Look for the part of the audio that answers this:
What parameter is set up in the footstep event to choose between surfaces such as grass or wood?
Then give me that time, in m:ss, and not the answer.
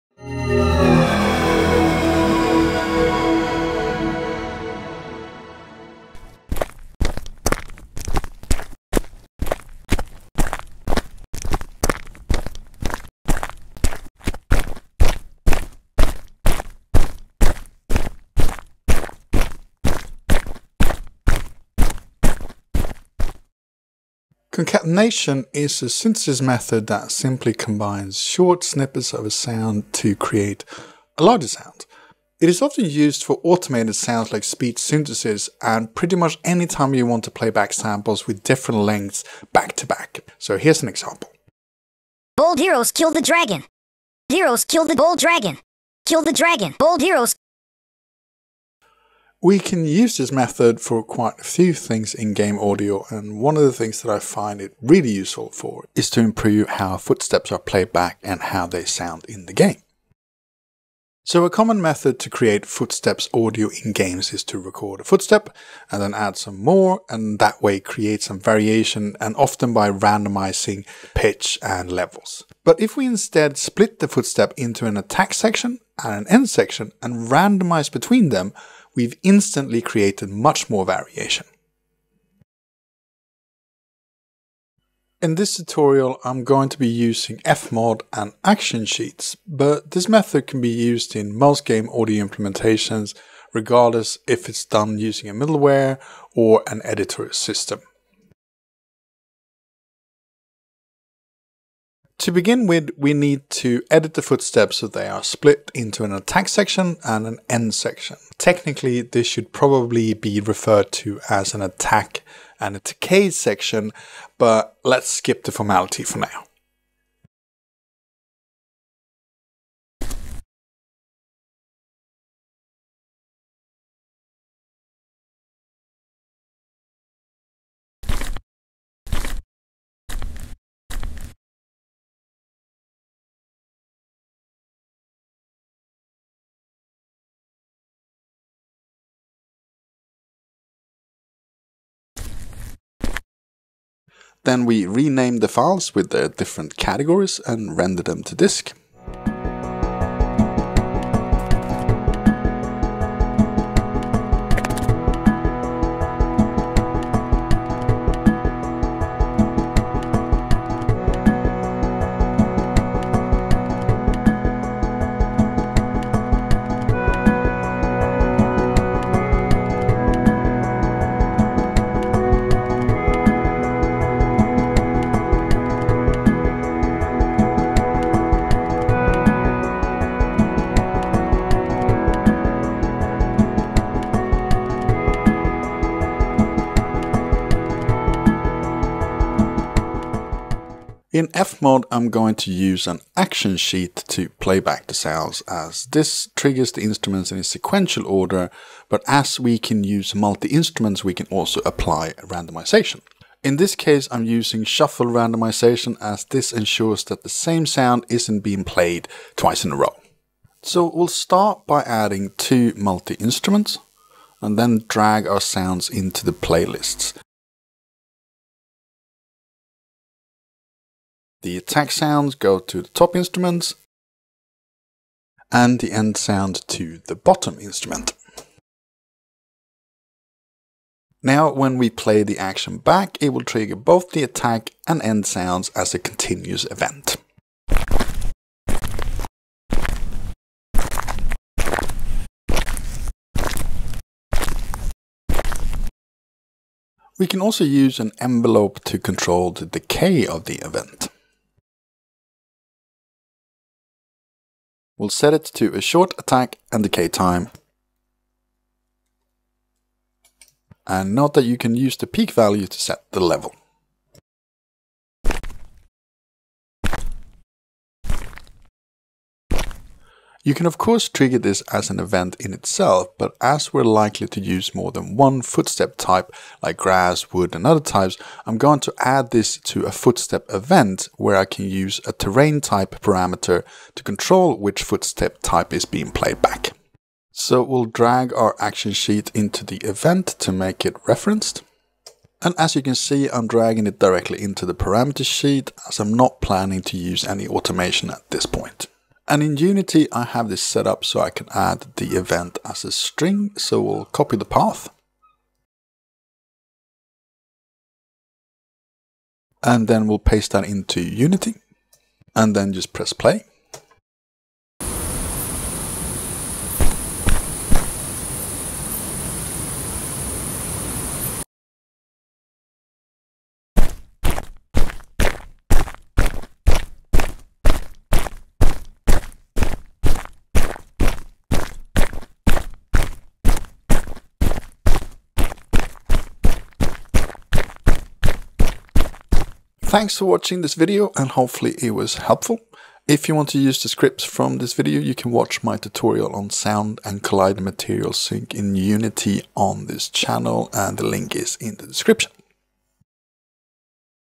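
4:42.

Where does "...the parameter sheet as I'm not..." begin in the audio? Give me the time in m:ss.
4:54.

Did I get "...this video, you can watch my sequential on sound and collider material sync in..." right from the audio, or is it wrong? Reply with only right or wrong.
wrong.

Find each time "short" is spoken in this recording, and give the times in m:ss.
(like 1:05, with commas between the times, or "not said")
0:28, 4:15.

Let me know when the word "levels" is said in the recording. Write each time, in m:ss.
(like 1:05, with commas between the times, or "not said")
1:11, 4:23.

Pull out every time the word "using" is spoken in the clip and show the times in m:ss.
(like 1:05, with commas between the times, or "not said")
1:26, 1:34, 3:24.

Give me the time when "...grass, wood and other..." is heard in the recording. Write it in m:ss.
4:36.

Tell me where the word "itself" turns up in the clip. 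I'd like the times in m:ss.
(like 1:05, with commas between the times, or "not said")
4:32.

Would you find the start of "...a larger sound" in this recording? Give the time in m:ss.
0:31.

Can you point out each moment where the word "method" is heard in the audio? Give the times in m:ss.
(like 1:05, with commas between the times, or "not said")
0:26, 0:50, 1:01, 1:30.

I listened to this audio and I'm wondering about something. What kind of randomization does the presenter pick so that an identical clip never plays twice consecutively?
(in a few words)
shuffle randomization.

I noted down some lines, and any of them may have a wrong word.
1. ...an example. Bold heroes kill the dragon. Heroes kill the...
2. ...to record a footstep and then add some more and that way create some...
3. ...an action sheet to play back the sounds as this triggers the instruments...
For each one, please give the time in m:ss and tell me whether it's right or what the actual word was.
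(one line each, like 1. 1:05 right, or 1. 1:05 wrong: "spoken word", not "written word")
1. 0:40 right
2. 1:04 right
3. 3:12 right.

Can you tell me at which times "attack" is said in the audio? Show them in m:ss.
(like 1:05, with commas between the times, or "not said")
1:14, 1:46, 1:51, 3:41, 3:54, 4:16.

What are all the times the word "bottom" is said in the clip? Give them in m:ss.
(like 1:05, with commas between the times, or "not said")
3:47.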